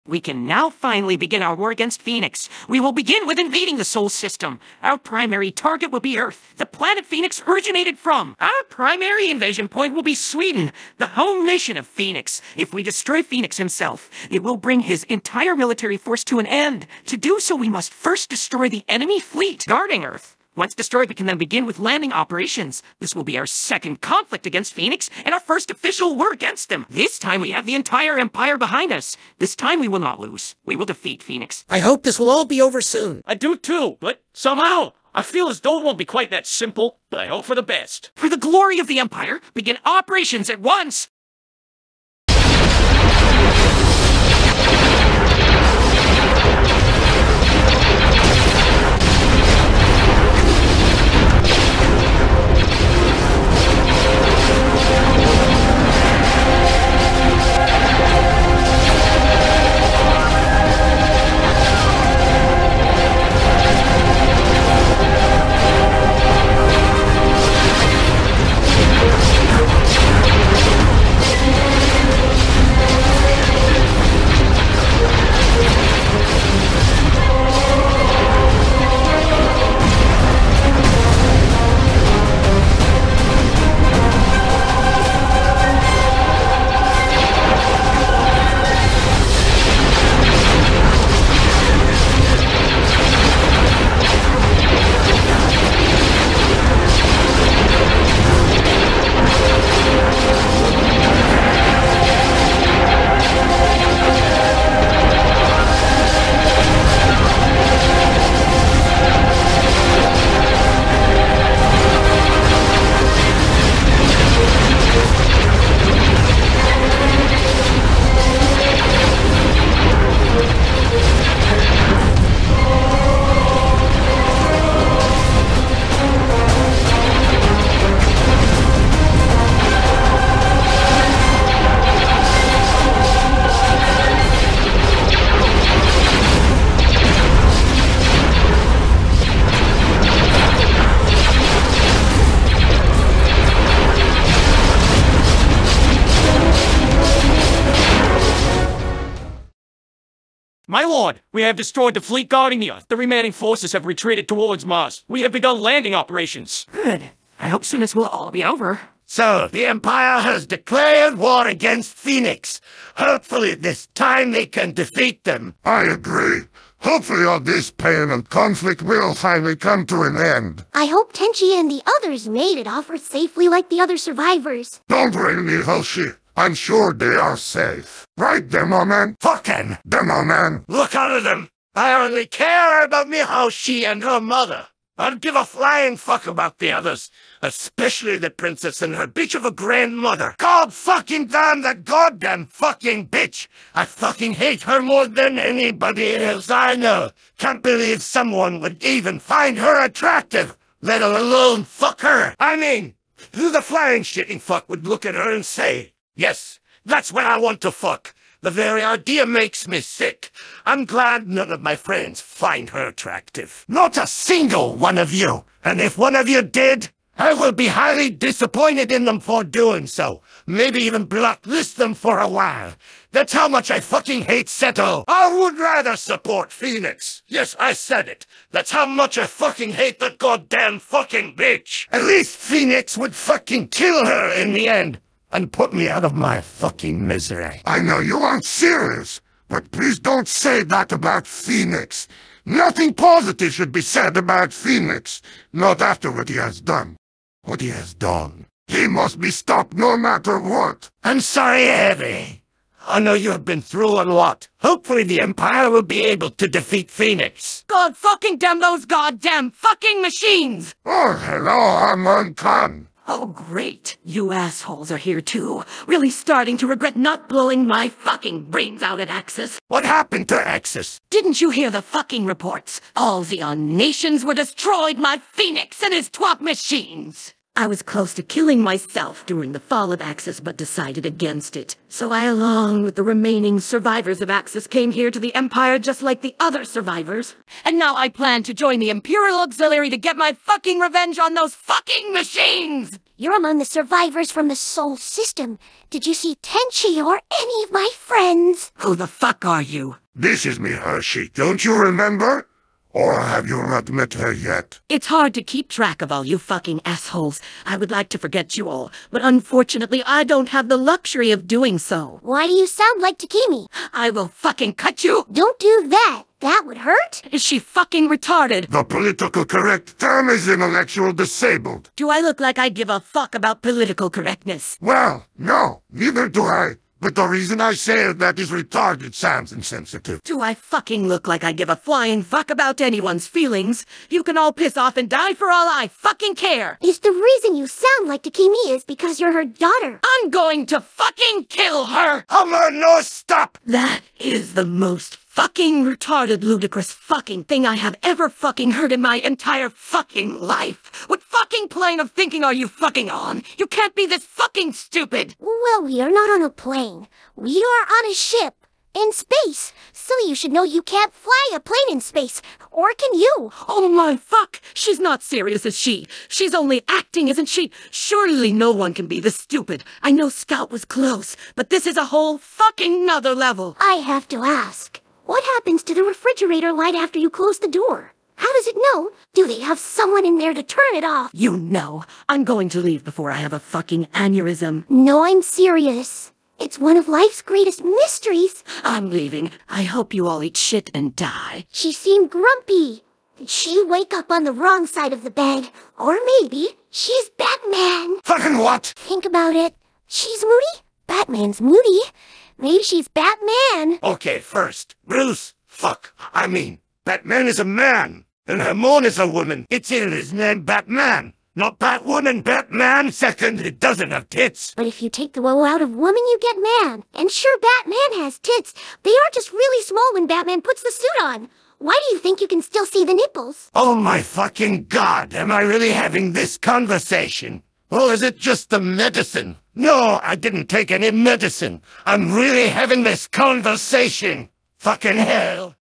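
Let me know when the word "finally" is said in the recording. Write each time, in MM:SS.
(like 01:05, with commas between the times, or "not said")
00:00, 02:49.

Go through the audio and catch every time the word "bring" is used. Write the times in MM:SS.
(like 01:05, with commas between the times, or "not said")
00:14.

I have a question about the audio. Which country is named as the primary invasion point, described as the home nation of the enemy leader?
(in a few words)
Sweden.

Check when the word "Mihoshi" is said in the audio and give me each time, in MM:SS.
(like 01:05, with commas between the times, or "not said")
02:55, 03:03.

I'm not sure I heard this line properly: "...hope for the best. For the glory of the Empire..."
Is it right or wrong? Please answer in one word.
right.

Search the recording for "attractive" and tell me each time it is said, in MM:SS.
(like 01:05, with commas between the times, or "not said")
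03:19, 03:32.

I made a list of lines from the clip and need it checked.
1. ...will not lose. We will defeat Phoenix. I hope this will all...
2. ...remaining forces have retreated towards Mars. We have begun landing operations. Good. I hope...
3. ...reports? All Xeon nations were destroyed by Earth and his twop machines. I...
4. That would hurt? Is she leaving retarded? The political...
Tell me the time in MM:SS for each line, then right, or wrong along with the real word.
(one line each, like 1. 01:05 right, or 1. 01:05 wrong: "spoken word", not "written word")
1. 00:29 right
2. 02:32 right
3. 04:32 wrong: "Phoenix", not "Earth"
4. 05:16 wrong: "fucking", not "leaving".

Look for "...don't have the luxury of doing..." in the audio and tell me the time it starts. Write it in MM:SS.
05:10.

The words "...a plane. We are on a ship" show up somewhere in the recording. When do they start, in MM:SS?
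05:56.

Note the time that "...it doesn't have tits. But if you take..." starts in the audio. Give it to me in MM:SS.
06:53.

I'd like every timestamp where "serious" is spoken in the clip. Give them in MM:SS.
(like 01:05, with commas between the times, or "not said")
03:58, 06:05, 06:25.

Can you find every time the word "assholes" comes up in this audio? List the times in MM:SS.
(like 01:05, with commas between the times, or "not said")
04:24, 05:06.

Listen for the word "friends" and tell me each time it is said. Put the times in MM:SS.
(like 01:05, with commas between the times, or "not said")
03:31, 04:57.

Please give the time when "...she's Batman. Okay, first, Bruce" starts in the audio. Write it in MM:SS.
06:42.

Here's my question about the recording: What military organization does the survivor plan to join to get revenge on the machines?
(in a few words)
Imperial Auxiliary.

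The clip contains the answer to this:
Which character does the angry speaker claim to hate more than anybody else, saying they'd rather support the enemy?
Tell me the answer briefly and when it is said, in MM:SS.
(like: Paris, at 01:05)
Seto, at 03:44.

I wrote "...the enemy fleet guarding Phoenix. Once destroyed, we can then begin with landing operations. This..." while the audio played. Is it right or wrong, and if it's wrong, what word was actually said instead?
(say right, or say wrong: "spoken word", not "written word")
wrong: "Earth", not "Phoenix".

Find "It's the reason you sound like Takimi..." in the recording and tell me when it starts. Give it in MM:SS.
05:36.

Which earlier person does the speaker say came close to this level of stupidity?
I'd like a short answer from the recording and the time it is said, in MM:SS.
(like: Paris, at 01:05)
Scout, at 06:10.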